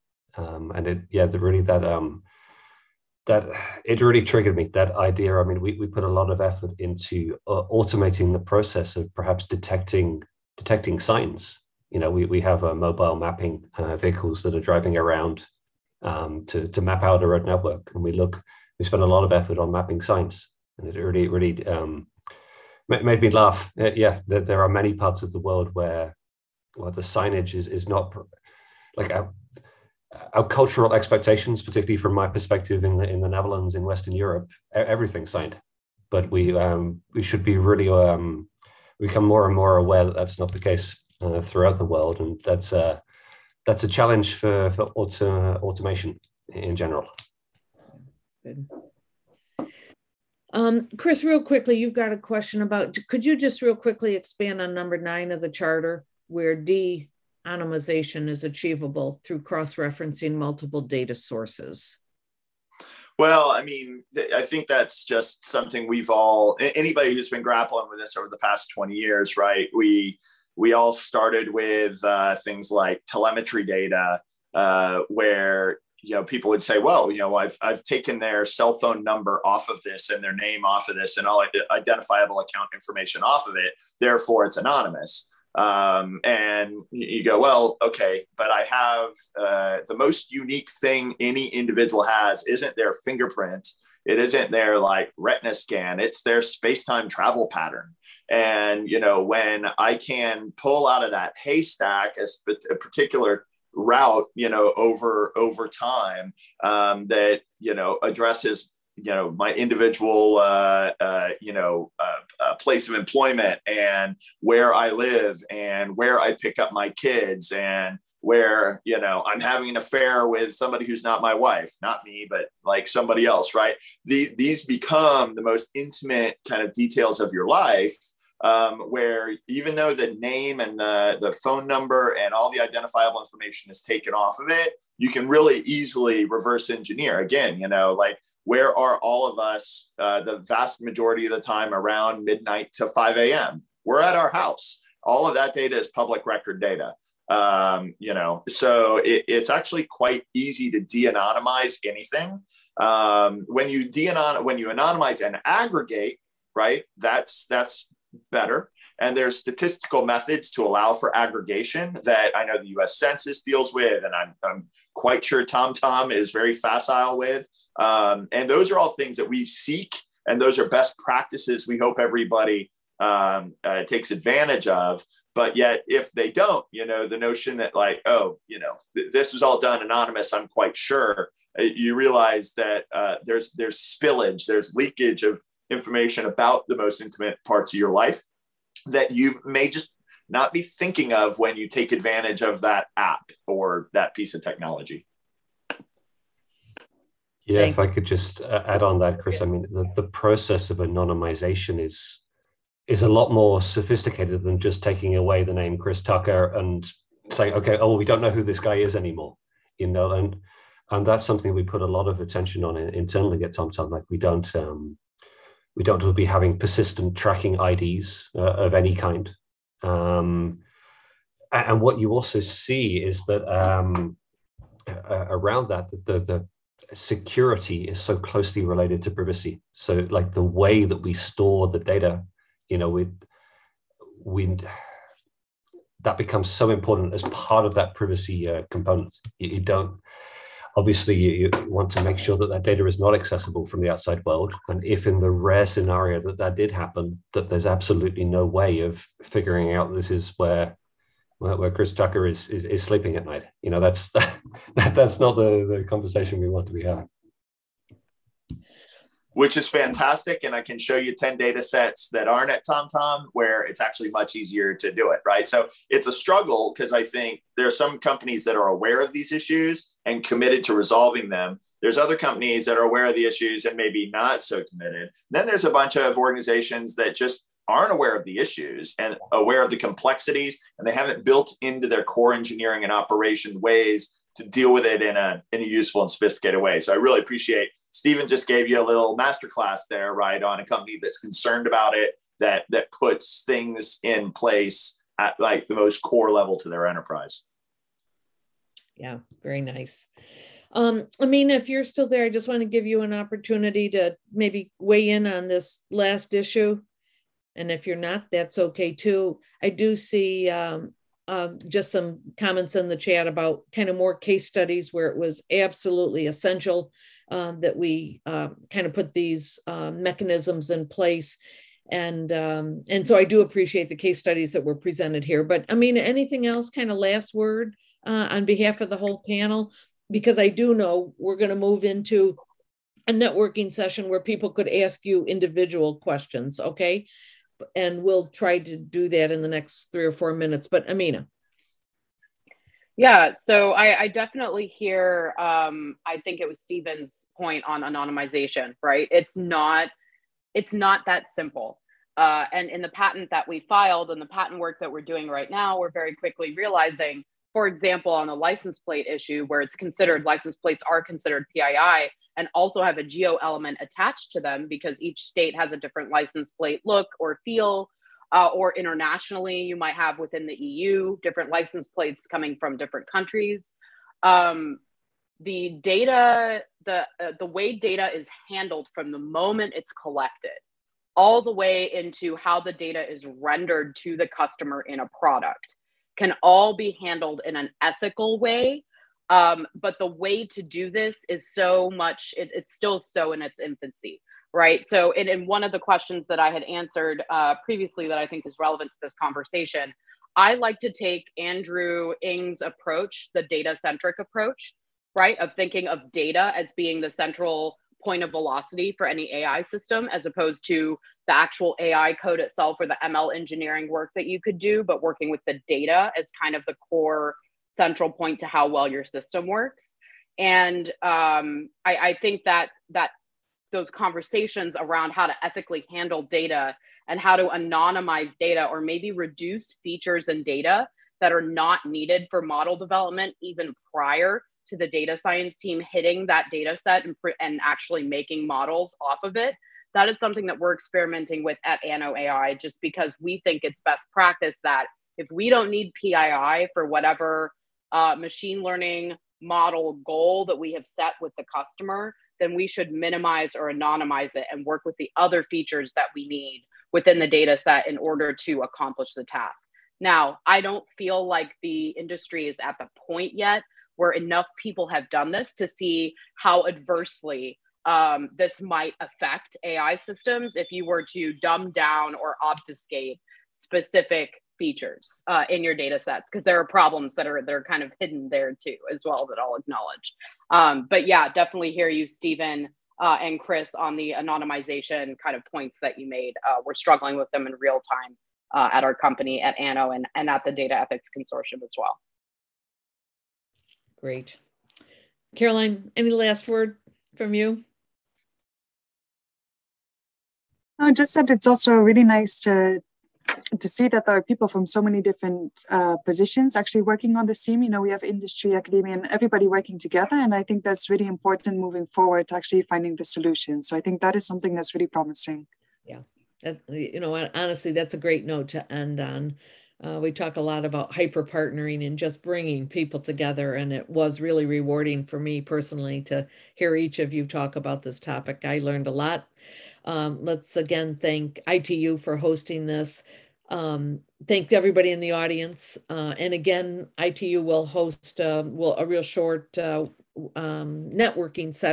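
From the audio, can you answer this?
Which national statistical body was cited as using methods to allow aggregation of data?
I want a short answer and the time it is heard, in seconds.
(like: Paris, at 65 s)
US Census, at 162 s.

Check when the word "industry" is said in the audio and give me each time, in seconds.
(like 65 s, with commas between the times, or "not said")
461 s, 508 s.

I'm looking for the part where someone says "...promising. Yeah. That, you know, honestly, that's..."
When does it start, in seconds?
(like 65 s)
514 s.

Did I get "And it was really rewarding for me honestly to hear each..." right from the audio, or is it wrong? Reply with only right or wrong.
wrong.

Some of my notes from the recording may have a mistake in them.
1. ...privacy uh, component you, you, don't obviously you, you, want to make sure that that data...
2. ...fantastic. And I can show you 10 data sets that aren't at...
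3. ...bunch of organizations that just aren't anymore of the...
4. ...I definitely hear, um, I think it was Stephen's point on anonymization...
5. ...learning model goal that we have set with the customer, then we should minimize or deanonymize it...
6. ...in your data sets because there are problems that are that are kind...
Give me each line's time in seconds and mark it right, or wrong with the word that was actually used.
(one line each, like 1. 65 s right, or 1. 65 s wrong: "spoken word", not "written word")
1. 237 s right
2. 259 s right
3. 275 s wrong: "aware", not "anymore"
4. 344 s right
5. 448 s wrong: "anonymize", not "deanonymize"
6. 475 s right.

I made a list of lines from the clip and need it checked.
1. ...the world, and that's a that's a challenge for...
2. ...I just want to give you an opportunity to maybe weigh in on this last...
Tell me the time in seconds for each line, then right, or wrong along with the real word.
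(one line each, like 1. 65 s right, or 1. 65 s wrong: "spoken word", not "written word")
1. 41 s right
2. 302 s right.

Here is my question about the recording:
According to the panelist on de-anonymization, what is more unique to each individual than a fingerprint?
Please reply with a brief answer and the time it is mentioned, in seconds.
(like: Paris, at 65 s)
space time travel pattern, at 96 s.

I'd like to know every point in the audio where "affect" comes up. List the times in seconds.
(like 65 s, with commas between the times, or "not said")
468 s.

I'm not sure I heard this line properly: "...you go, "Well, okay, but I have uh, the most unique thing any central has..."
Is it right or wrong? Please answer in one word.
wrong.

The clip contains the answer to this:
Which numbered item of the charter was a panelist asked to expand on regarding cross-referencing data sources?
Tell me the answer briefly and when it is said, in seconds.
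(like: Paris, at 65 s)
9, at 54 s.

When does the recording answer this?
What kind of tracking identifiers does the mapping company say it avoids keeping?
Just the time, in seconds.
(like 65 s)
216 s.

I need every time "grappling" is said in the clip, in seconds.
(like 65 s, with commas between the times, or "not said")
67 s.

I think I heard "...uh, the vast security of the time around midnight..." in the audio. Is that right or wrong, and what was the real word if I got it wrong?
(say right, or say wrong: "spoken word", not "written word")
wrong: "majority", not "security".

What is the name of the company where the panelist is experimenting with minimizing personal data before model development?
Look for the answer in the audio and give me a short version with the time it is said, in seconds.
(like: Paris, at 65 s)
Anno.ai, at 441 s.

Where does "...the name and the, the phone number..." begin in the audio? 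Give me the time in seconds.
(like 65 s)
129 s.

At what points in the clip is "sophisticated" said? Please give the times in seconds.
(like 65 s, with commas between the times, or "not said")
203 s, 286 s.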